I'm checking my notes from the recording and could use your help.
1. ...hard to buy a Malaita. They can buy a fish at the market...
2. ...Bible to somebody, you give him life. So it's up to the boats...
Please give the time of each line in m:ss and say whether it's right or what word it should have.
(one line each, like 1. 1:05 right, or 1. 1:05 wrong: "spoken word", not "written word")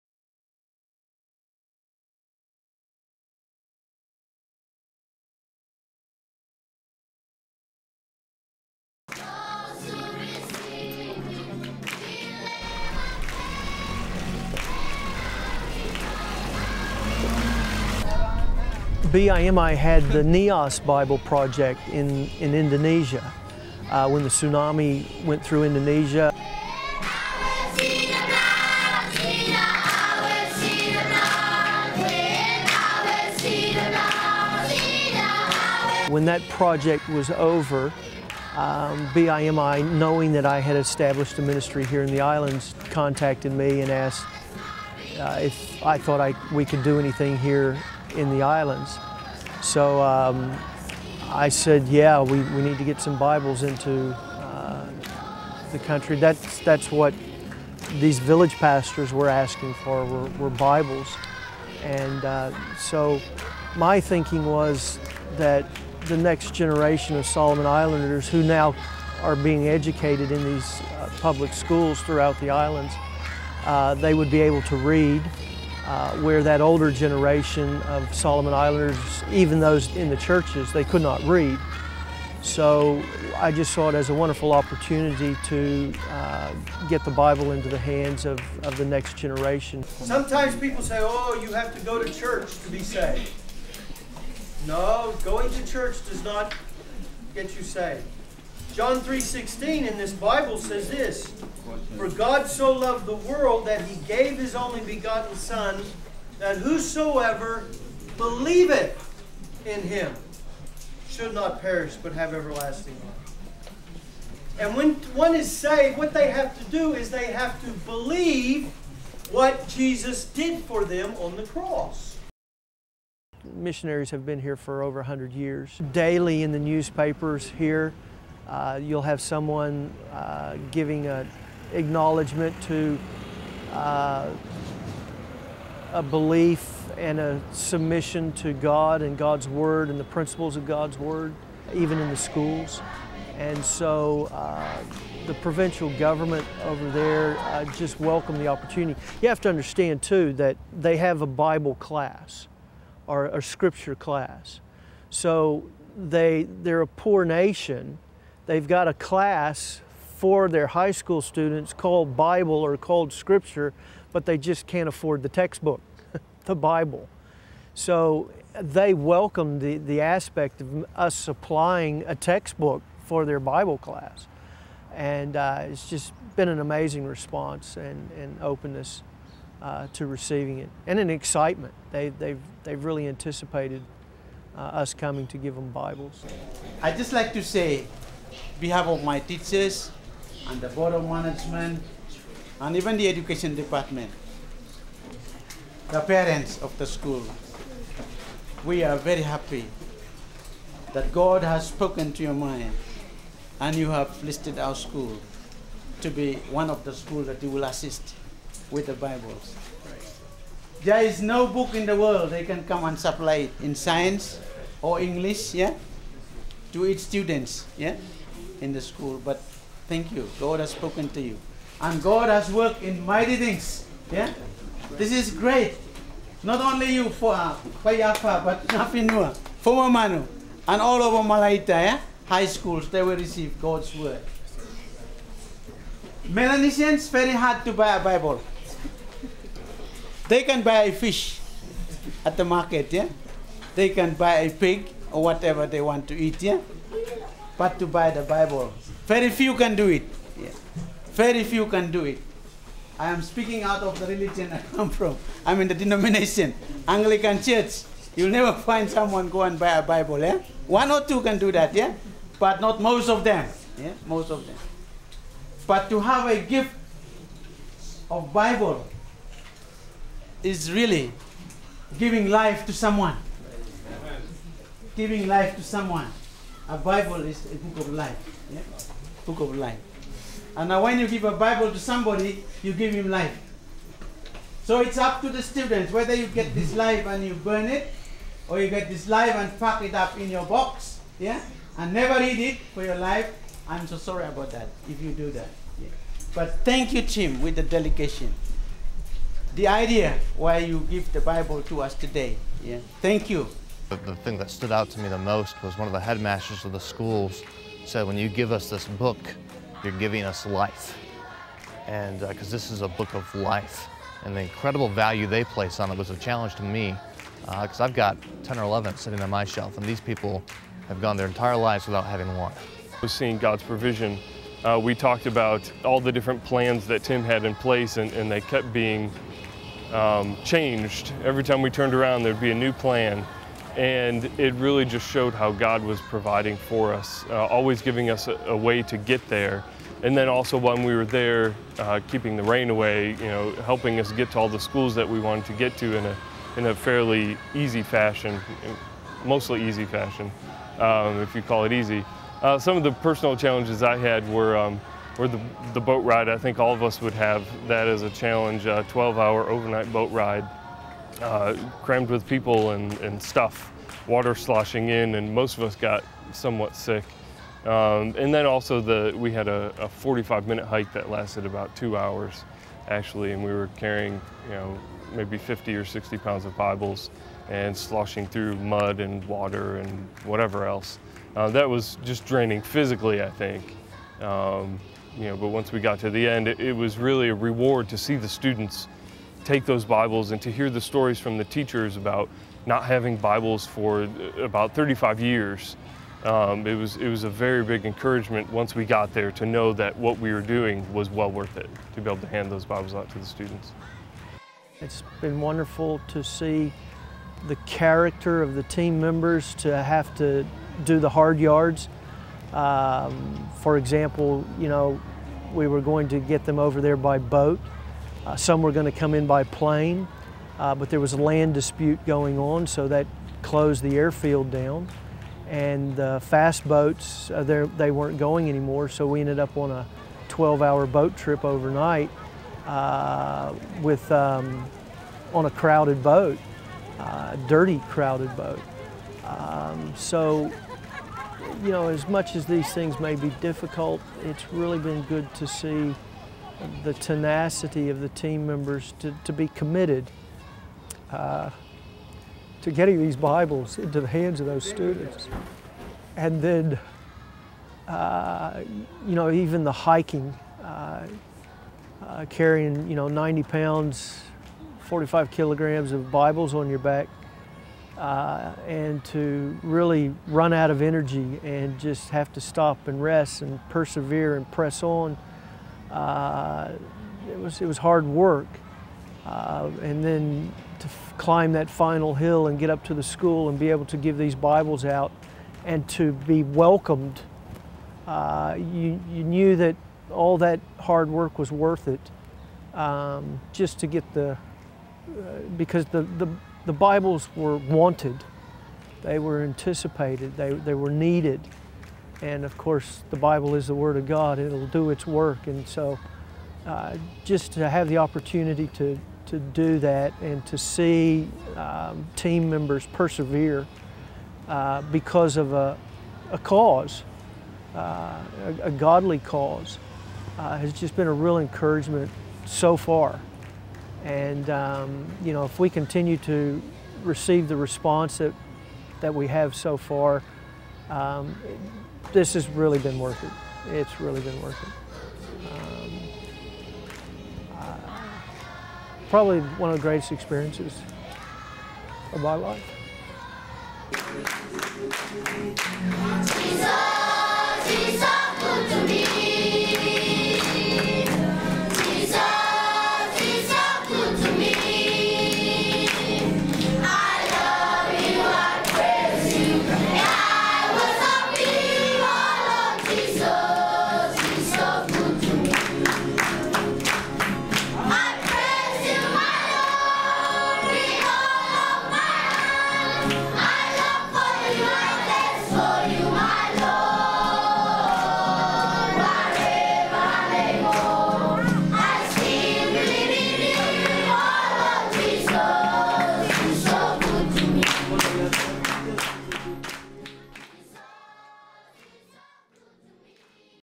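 1. 3:57 wrong: "Bible", not "Malaita"
2. 4:41 wrong: "students", not "boats".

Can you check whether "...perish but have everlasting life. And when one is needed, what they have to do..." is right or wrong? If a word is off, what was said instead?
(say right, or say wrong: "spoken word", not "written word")
wrong: "saved", not "needed".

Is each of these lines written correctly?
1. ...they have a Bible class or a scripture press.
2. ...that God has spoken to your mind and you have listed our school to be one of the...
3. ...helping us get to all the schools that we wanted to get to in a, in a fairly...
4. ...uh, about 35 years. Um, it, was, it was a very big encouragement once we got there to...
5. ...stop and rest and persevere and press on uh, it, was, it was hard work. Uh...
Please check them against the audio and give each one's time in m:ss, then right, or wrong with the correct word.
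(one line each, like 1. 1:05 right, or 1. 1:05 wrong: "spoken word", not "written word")
1. 2:30 wrong: "class", not "press"
2. 3:20 right
3. 5:43 right
4. 6:34 right
5. 7:52 right.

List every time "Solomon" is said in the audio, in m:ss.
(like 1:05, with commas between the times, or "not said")
1:07, 1:18.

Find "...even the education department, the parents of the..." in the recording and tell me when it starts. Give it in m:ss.
3:12.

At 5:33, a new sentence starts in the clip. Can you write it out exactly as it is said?
And it really just showed how God was providing for us, uh, always giving us a, a, way to get there.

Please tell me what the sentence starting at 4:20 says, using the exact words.
One or two can do that, yeah?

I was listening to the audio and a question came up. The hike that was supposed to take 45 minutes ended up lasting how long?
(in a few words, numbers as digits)
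About 2 hours.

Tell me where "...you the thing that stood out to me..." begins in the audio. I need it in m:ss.
5:03.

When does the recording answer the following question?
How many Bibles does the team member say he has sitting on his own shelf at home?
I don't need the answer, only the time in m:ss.
5:18.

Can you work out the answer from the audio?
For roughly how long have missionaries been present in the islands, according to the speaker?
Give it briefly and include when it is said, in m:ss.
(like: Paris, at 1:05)
Over 100 years, at 2:04.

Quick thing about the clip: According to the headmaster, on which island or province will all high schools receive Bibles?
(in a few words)
Malaita.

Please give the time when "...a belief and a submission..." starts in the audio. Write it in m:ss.
2:15.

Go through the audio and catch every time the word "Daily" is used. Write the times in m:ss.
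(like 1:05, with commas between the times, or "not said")
2:05.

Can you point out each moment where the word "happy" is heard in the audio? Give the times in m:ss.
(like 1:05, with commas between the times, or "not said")
3:19.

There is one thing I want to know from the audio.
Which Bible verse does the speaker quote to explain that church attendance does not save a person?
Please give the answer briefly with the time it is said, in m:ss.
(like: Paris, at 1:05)
John 3:16, at 1:38.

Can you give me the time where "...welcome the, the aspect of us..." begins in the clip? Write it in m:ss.
2:48.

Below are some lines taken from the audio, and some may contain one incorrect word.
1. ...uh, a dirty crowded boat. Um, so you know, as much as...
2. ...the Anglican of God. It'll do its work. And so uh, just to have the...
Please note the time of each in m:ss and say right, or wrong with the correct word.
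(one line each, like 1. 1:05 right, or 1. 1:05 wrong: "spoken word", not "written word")
1. 7:16 right
2. 8:23 wrong: "Word", not "Anglican".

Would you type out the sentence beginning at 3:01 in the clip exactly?
They, they've, they've really anticipated uh, us coming to give them Bibles.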